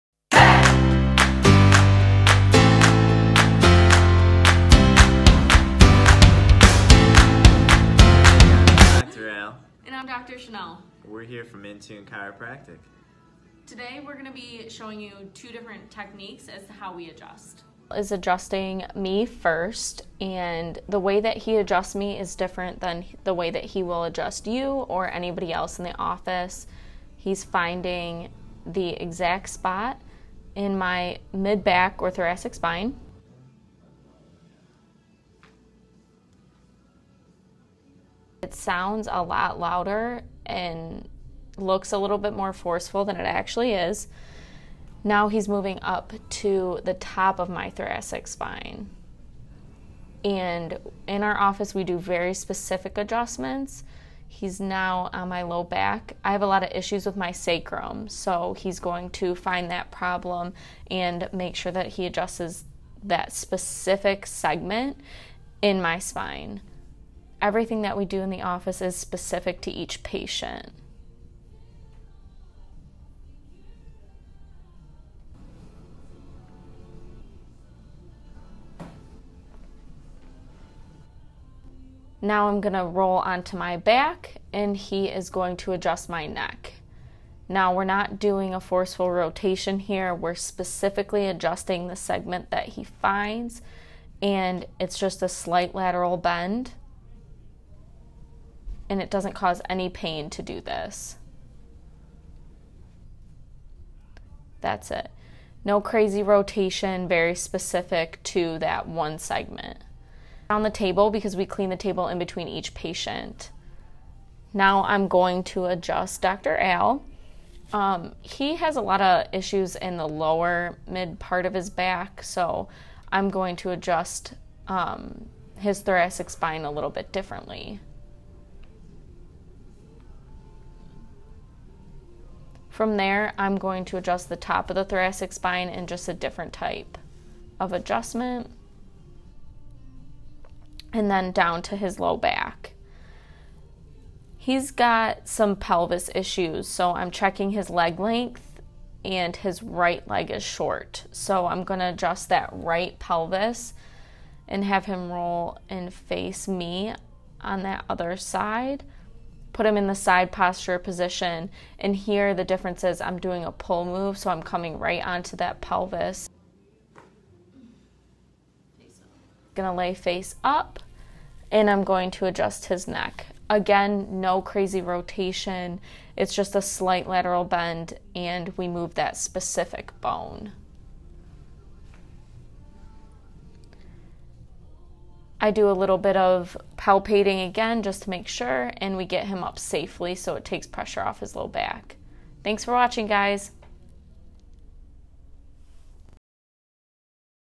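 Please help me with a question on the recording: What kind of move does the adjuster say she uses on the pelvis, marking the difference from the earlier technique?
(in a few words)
pull move.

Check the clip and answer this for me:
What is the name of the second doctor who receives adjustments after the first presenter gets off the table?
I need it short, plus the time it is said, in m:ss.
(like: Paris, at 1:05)
Dr. Al, at 1:56.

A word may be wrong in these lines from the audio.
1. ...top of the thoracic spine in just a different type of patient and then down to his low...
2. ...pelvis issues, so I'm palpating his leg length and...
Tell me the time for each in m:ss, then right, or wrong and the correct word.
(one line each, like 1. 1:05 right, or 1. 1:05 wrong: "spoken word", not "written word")
1. 2:14 wrong: "adjustment", not "patient"
2. 2:25 wrong: "checking", not "palpating".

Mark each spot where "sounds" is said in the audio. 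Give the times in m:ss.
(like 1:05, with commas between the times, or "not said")
0:38.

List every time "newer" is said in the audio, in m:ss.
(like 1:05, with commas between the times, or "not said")
not said.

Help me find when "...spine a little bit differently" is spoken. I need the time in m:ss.
2:06.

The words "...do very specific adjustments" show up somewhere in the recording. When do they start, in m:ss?
0:51.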